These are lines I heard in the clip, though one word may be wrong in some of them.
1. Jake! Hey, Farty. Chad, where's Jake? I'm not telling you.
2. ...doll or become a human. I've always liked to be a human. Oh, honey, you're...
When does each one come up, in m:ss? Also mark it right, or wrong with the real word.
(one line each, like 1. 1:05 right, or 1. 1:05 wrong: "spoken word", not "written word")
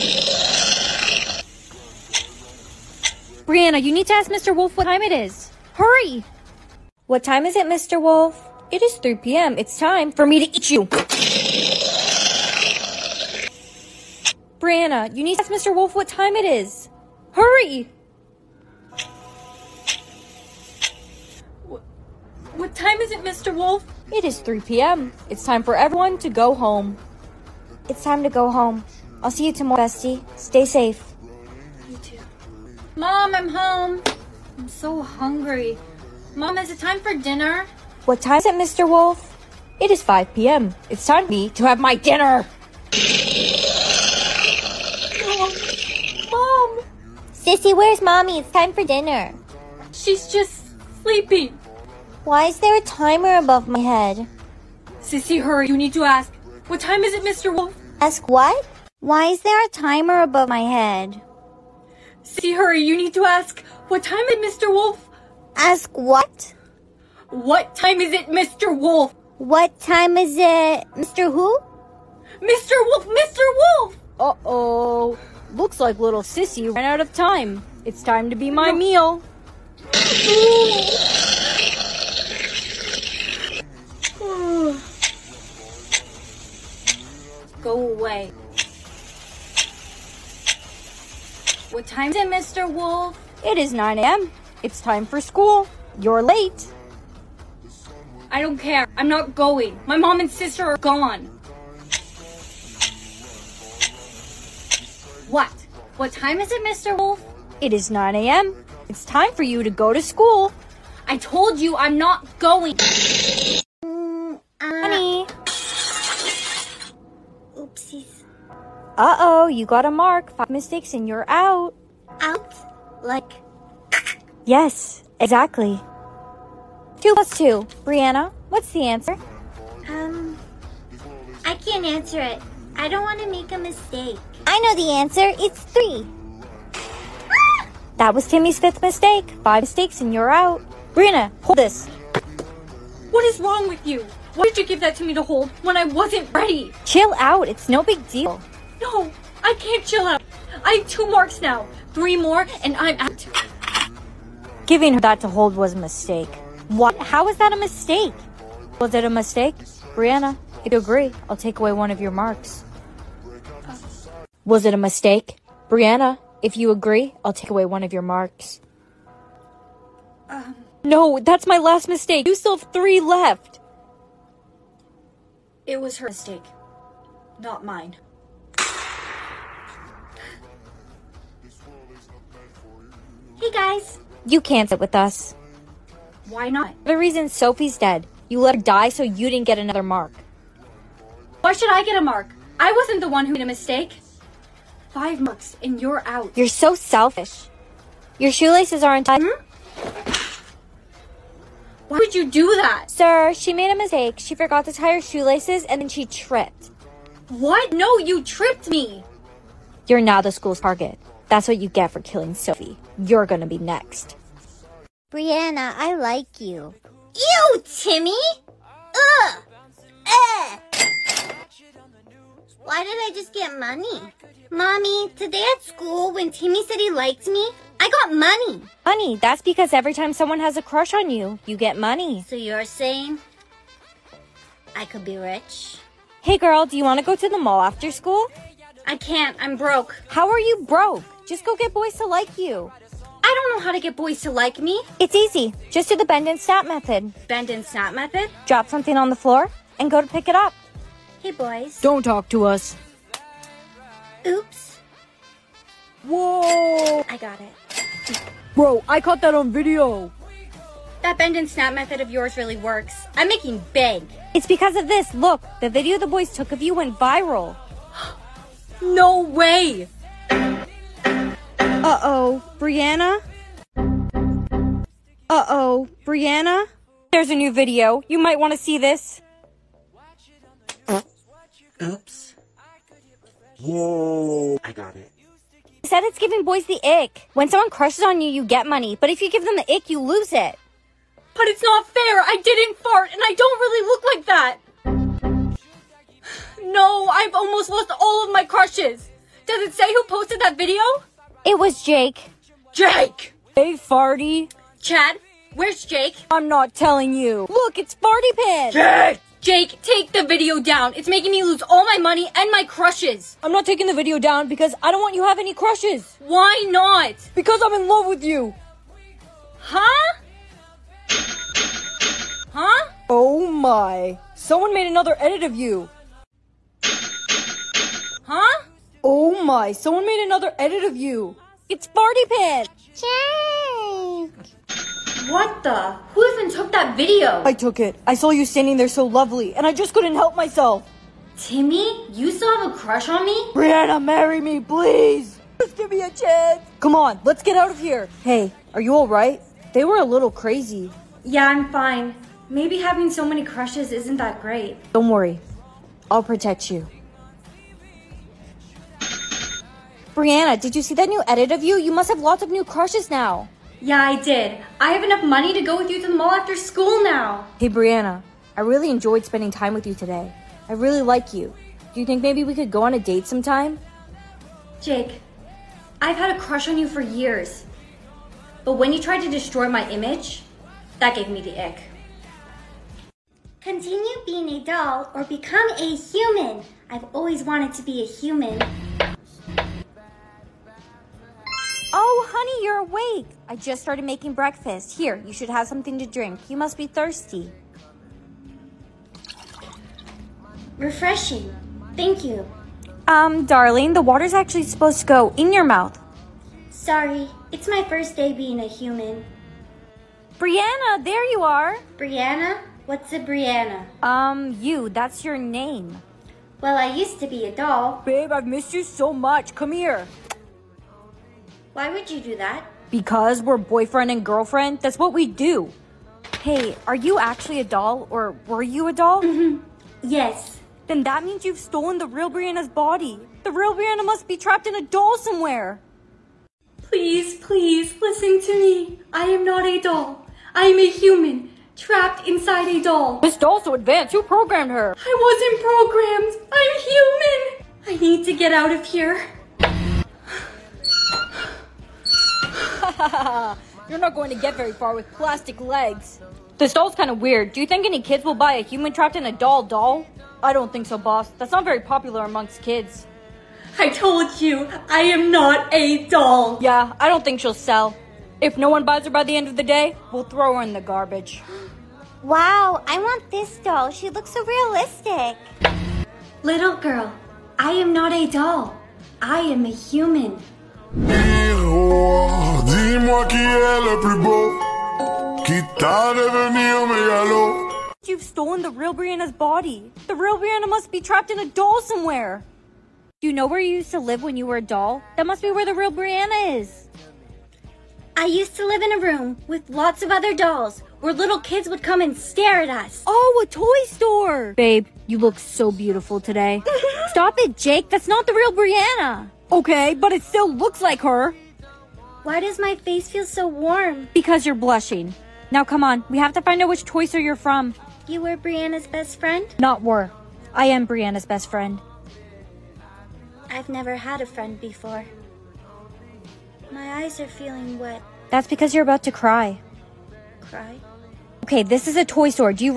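1. 5:02 right
2. 6:24 wrong: "wanted", not "liked".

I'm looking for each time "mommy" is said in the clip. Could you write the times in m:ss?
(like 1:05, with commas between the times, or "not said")
0:48, 3:44.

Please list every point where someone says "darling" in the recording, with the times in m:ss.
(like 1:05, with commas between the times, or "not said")
6:43.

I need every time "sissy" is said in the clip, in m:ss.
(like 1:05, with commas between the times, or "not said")
0:47, 0:55, 1:02, 1:16.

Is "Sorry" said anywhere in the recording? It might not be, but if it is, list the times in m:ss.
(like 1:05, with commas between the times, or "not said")
6:46.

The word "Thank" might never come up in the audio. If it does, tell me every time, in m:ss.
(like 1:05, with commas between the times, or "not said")
6:41.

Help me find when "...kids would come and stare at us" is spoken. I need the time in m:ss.
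8:21.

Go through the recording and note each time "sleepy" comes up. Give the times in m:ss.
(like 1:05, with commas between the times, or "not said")
0:51.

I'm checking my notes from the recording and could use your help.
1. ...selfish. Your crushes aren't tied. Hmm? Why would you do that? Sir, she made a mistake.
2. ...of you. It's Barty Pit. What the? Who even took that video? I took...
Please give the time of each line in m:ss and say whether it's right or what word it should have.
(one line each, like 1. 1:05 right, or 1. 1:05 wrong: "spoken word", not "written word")
1. 3:16 wrong: "shoelaces", not "crushes"
2. 5:30 right.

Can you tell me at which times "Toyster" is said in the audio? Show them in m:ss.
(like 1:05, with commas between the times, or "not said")
8:36.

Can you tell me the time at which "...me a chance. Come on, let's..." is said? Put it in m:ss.
5:45.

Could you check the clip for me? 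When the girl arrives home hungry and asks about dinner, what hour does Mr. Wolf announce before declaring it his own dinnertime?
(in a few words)
5 p.m.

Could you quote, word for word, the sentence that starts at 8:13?
Do you know where you used to live when you were a doll?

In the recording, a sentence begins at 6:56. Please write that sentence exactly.
Well, I used to be a doll.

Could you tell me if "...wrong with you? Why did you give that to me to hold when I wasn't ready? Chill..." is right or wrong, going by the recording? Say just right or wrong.
right.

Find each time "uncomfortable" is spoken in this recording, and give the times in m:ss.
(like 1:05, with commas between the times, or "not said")
not said.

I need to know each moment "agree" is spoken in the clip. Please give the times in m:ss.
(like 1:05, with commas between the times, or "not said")
2:40, 2:46.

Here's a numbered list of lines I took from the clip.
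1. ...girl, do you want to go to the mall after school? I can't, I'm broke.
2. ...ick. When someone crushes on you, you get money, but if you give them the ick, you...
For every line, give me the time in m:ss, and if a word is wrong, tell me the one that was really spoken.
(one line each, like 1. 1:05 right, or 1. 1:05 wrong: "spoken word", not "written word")
1. 3:56 right
2. 4:46 right.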